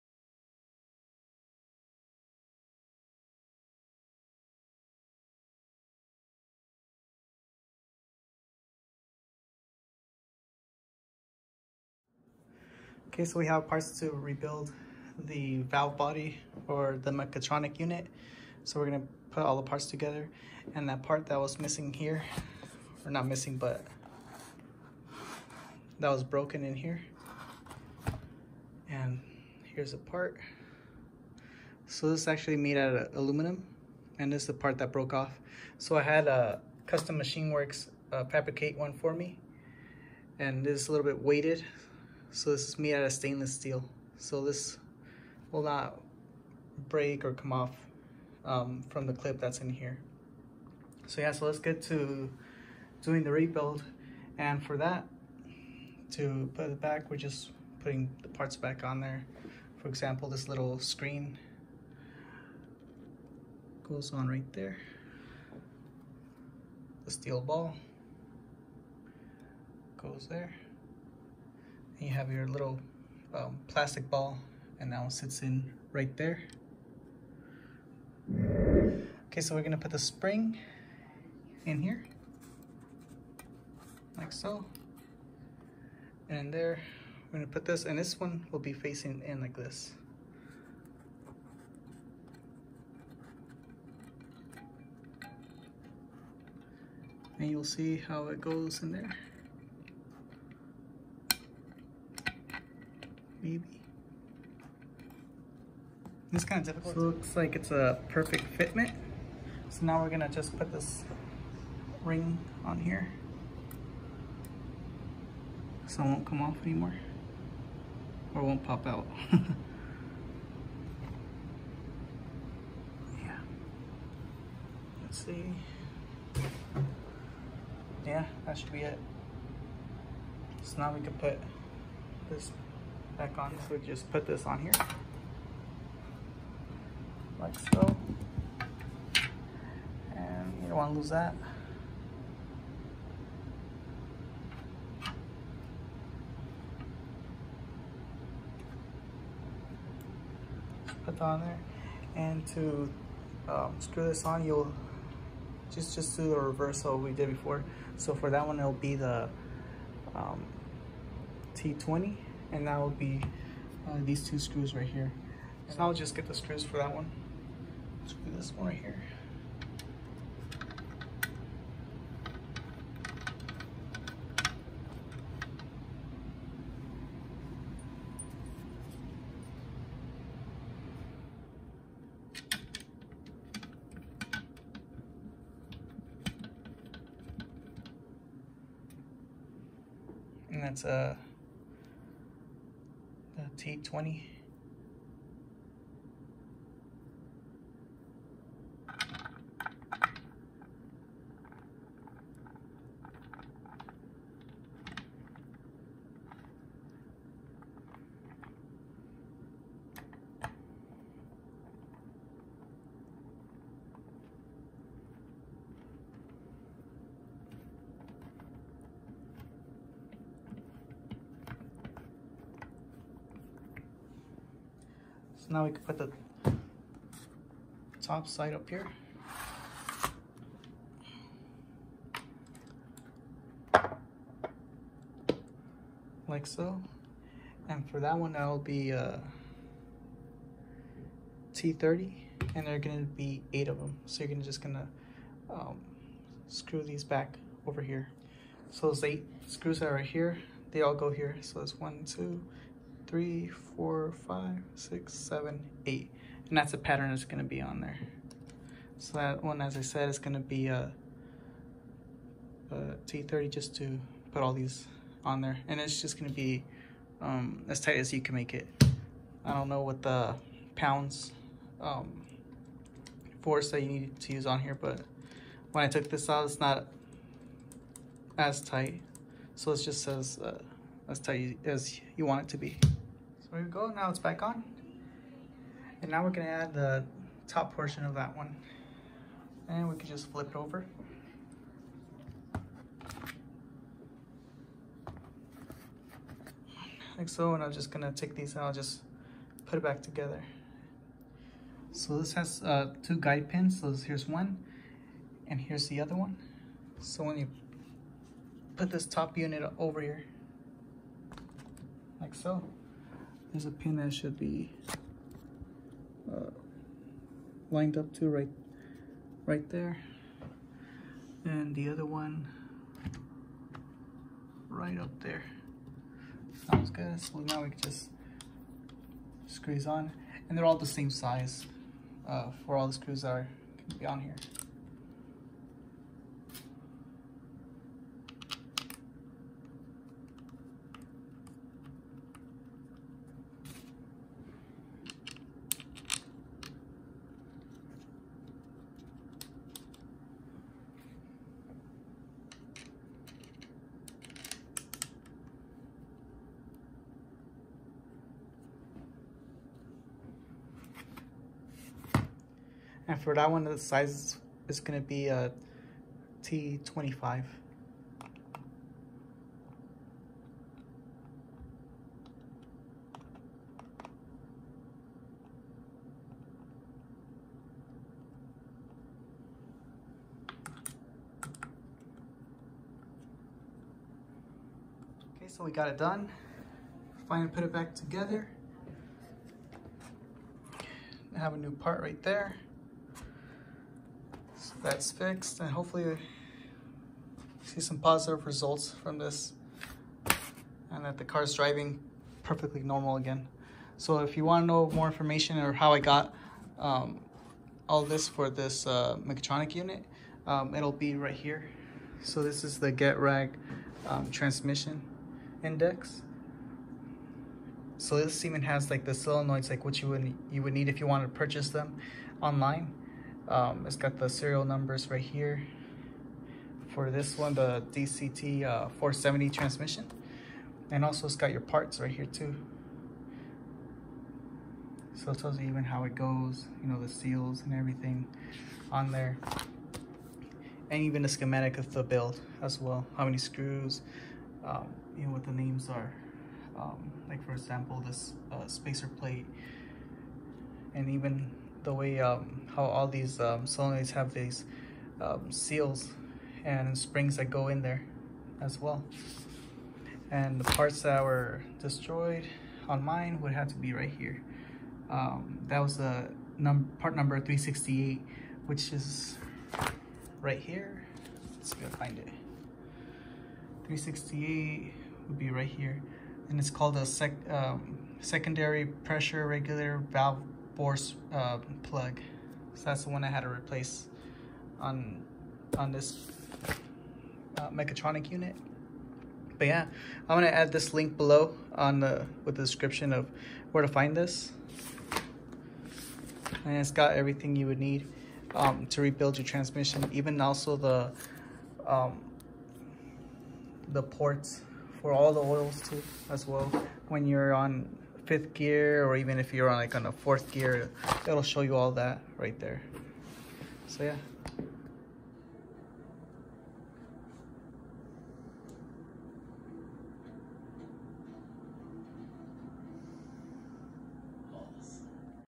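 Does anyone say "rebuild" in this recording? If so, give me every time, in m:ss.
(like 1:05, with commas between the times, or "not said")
0:14, 0:53, 8:19.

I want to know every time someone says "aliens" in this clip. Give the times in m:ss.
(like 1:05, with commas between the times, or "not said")
not said.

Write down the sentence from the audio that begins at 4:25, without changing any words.
And it's just gonna be um, as tight as you can make it.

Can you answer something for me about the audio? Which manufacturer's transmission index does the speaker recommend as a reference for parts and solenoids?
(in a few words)
Getrag.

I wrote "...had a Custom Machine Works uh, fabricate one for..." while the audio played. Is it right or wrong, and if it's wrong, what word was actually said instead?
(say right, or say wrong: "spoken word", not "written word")
right.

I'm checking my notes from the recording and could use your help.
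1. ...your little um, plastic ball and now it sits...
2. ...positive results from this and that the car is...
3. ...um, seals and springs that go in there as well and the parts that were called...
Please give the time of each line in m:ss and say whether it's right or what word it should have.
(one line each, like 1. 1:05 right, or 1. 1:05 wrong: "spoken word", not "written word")
1. 1:12 right
2. 6:37 right
3. 7:35 wrong: "destroyed", not "called".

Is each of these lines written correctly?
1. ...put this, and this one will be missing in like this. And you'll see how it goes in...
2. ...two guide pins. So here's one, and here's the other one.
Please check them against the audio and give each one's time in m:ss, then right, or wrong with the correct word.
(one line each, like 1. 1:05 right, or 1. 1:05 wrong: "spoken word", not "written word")
1. 1:27 wrong: "facing", not "missing"
2. 5:03 right.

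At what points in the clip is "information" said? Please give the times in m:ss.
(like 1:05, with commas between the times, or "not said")
6:45.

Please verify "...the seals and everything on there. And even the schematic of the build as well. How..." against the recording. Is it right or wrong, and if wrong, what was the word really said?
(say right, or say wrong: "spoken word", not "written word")
right.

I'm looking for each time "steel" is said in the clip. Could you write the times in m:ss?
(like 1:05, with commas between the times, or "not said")
0:43, 1:07.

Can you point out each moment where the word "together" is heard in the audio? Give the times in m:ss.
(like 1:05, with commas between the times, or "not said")
0:19, 5:00, 6:27.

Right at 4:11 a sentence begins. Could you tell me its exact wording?
So it's one, two, three, four, five, six, seven, eight.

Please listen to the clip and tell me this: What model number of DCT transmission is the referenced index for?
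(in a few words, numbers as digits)
470.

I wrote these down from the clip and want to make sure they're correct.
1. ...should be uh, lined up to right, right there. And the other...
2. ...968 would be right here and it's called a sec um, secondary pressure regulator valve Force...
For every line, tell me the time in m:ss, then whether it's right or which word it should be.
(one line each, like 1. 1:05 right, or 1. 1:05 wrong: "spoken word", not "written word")
1. 5:14 right
2. 7:53 wrong: "368", not "968".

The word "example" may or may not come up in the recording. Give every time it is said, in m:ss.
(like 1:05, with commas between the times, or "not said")
0:59, 7:27.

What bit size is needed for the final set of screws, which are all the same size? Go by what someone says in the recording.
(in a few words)
T25.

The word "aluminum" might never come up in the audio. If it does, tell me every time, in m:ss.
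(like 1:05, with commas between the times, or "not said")
0:33.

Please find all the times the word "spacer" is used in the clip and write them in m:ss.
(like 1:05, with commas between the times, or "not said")
7:28.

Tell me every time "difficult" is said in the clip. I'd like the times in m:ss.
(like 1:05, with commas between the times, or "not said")
1:46.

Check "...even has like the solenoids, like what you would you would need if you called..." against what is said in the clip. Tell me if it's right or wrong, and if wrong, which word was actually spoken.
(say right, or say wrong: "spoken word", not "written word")
wrong: "wanted", not "called".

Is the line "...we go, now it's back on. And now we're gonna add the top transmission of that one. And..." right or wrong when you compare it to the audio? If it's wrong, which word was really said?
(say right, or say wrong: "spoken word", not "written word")
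wrong: "portion", not "transmission".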